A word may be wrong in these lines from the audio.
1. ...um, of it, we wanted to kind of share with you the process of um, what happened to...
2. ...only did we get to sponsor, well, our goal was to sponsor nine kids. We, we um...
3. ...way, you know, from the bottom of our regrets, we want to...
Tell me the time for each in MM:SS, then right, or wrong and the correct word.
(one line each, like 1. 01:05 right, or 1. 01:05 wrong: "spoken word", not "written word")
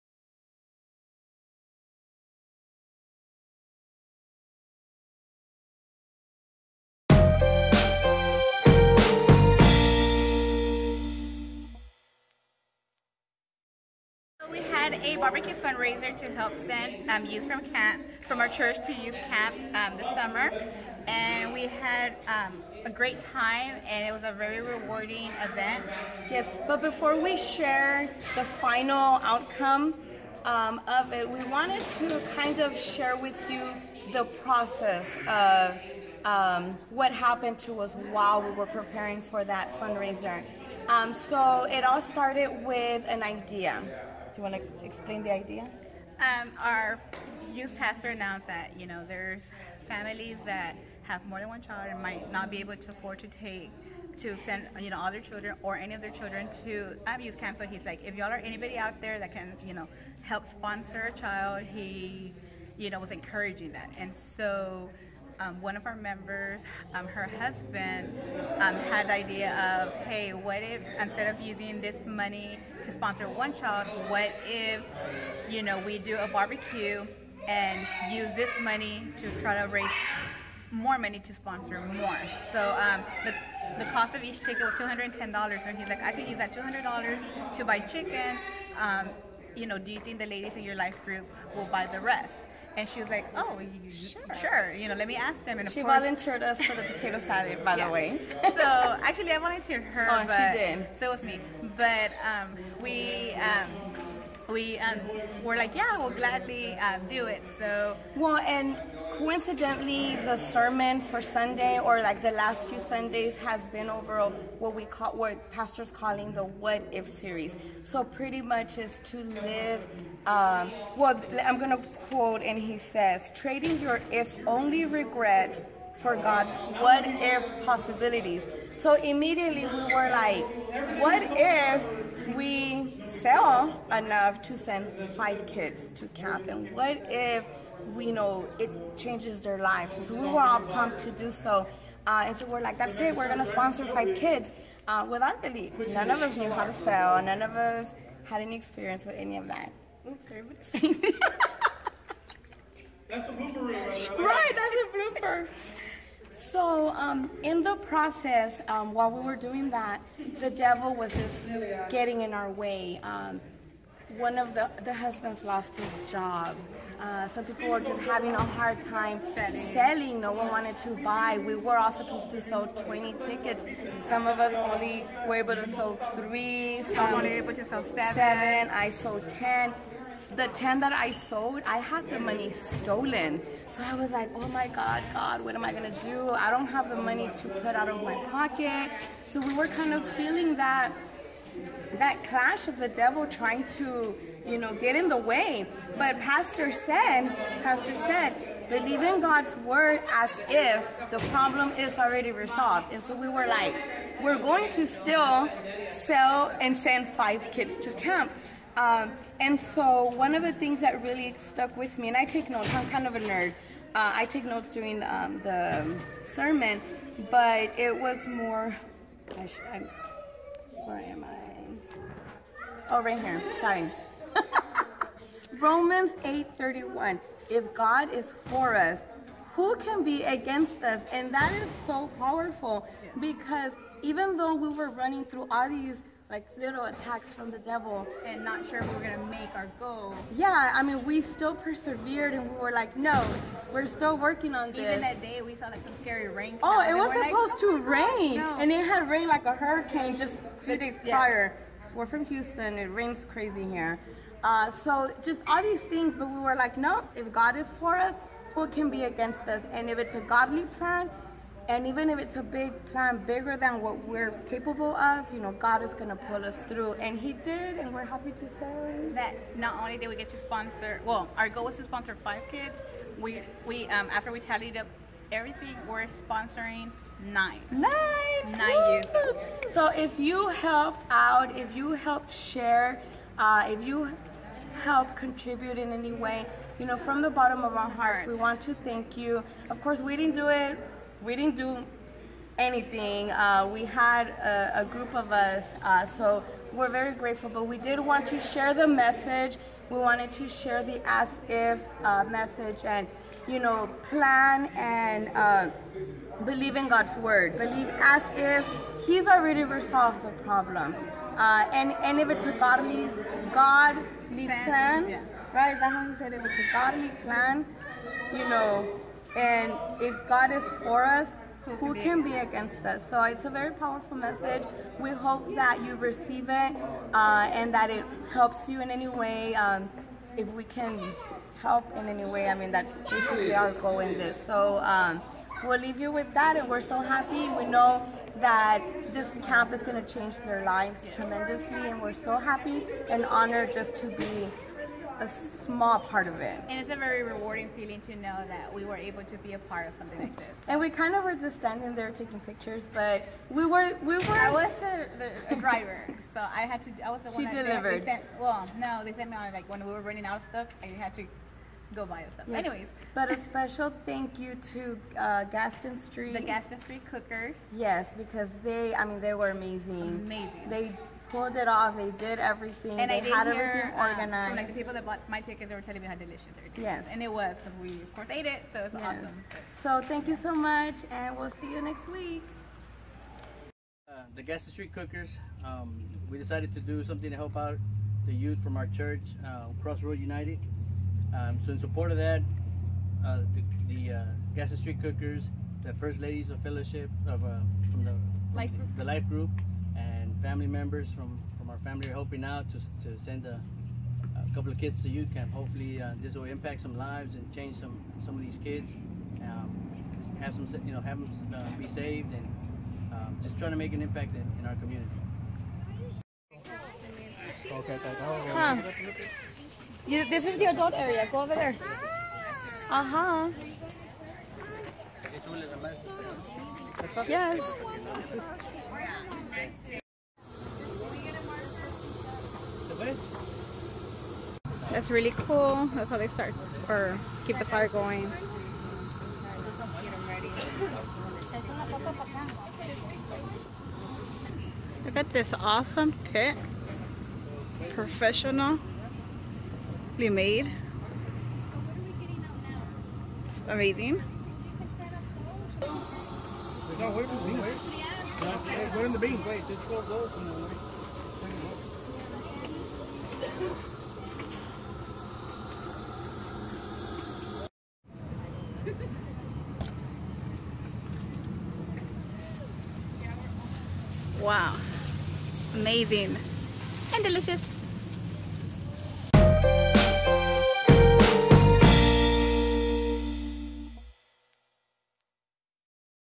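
1. 00:30 right
2. 04:29 wrong: "five", not "nine"
3. 04:46 wrong: "hearts", not "regrets".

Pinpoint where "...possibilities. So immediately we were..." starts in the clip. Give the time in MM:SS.
02:07.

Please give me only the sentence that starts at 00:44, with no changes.
You want to explain the idea?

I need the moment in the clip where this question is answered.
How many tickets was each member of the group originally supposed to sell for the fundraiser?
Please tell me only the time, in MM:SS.
02:52.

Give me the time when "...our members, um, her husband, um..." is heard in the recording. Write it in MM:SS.
01:05.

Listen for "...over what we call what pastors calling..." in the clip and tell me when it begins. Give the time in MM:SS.
01:53.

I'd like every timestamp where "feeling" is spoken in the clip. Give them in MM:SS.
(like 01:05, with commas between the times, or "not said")
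03:10, 05:47.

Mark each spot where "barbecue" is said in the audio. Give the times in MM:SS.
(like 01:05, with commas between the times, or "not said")
00:15, 01:16.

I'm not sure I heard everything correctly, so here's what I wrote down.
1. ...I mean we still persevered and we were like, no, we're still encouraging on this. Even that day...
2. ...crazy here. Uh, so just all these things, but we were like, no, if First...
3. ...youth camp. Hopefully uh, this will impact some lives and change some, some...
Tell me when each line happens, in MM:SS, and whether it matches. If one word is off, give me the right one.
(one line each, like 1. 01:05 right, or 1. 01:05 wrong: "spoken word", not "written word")
1. 04:00 wrong: "working", not "encouraging"
2. 04:13 wrong: "God", not "First"
3. 06:45 right.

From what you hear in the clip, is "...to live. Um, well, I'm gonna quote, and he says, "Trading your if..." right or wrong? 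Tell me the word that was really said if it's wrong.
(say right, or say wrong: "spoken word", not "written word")
right.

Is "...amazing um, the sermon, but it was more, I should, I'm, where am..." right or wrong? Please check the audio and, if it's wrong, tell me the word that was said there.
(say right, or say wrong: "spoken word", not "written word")
wrong: "during", not "amazing".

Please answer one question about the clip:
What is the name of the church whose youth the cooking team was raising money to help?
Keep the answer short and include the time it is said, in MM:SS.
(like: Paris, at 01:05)
Crossroad United, at 06:29.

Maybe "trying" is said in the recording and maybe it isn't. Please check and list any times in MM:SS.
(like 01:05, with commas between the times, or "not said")
03:13, 06:53.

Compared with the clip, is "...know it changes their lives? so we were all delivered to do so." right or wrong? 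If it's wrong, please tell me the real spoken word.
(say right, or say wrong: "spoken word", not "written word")
wrong: "pumped", not "delivered".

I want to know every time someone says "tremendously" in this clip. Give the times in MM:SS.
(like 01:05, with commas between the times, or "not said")
05:41.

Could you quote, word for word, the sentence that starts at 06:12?
And they I did had hear, everything organized.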